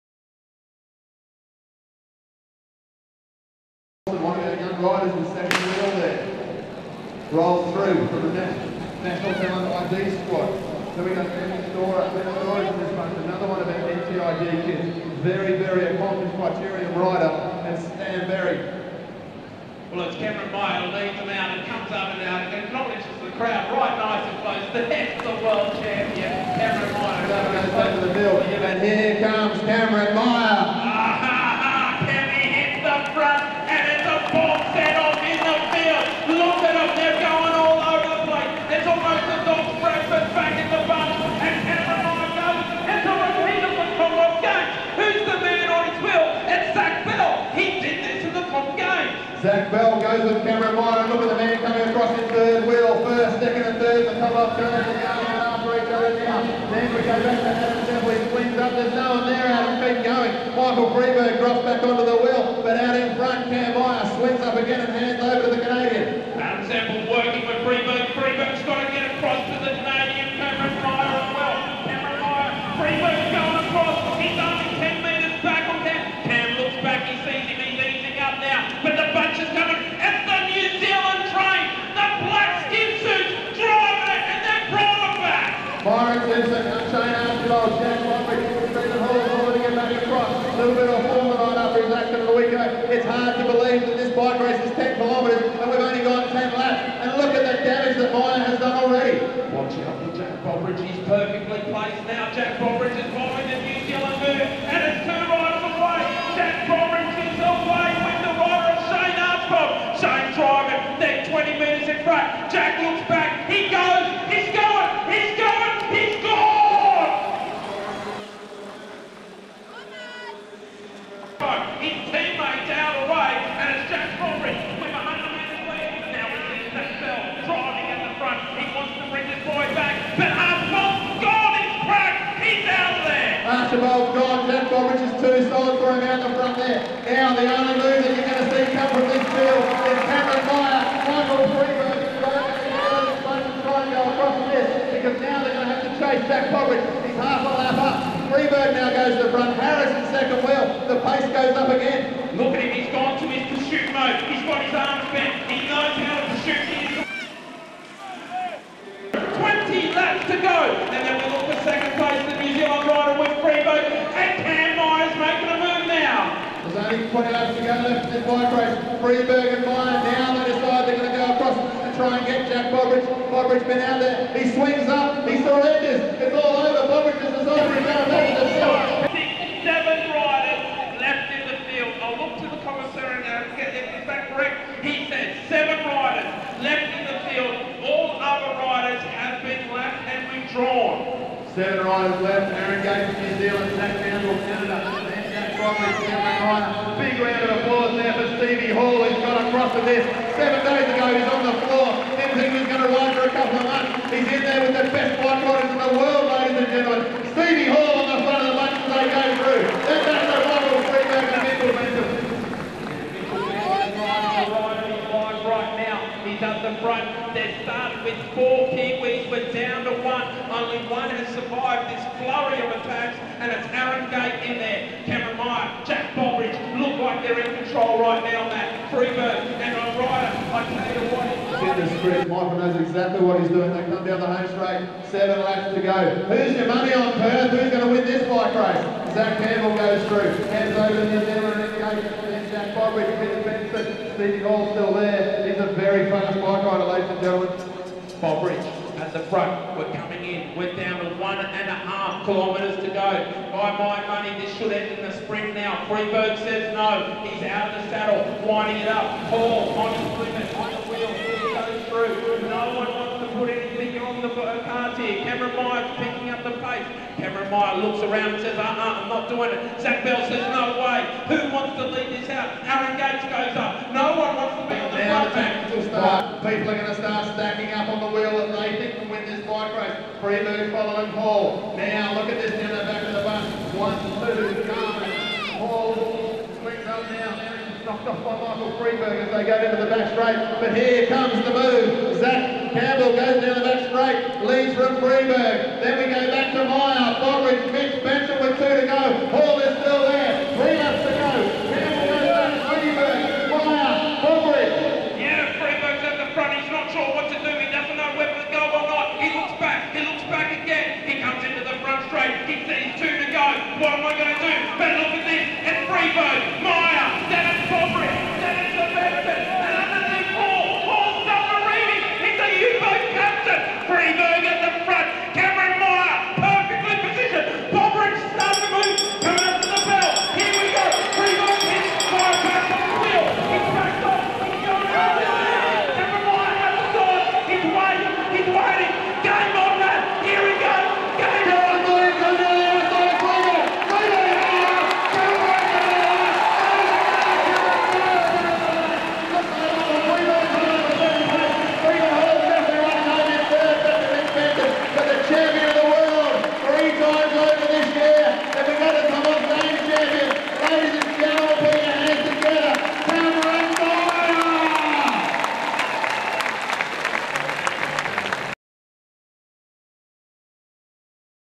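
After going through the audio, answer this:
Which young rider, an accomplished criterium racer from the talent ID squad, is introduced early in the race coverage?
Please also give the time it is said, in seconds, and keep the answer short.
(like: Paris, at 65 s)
Emma Storer, at 15 s.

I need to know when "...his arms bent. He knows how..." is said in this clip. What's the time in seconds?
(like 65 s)
154 s.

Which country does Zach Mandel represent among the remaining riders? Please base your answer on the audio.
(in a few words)
Canada.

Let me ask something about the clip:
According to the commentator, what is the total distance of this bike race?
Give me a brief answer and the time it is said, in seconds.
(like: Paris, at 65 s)
10 kilometres, at 94 s.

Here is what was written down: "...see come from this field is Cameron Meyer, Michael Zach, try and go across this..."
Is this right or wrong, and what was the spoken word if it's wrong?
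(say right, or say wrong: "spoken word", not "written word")
wrong: "Frieberg", not "Zach".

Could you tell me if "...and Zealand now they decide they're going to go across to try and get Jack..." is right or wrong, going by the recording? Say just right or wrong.
wrong.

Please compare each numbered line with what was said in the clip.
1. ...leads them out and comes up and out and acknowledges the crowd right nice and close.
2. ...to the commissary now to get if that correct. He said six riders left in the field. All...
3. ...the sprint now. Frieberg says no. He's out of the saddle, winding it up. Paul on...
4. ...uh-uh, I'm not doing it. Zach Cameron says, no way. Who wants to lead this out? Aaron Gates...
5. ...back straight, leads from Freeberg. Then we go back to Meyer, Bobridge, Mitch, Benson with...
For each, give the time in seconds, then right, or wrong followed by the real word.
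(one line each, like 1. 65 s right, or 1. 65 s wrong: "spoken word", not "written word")
1. 20 s right
2. 182 s wrong: "seven", not "six"
3. 255 s right
4. 268 s wrong: "Bell", not "Cameron"
5. 293 s right.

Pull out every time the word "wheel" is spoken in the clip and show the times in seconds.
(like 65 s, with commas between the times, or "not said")
5 s, 52 s, 62 s, 150 s, 260 s, 278 s.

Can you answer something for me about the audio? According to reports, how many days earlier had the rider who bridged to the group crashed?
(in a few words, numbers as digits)
7.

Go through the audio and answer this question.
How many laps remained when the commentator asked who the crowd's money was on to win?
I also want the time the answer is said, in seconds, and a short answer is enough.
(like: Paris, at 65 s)
7, at 235 s.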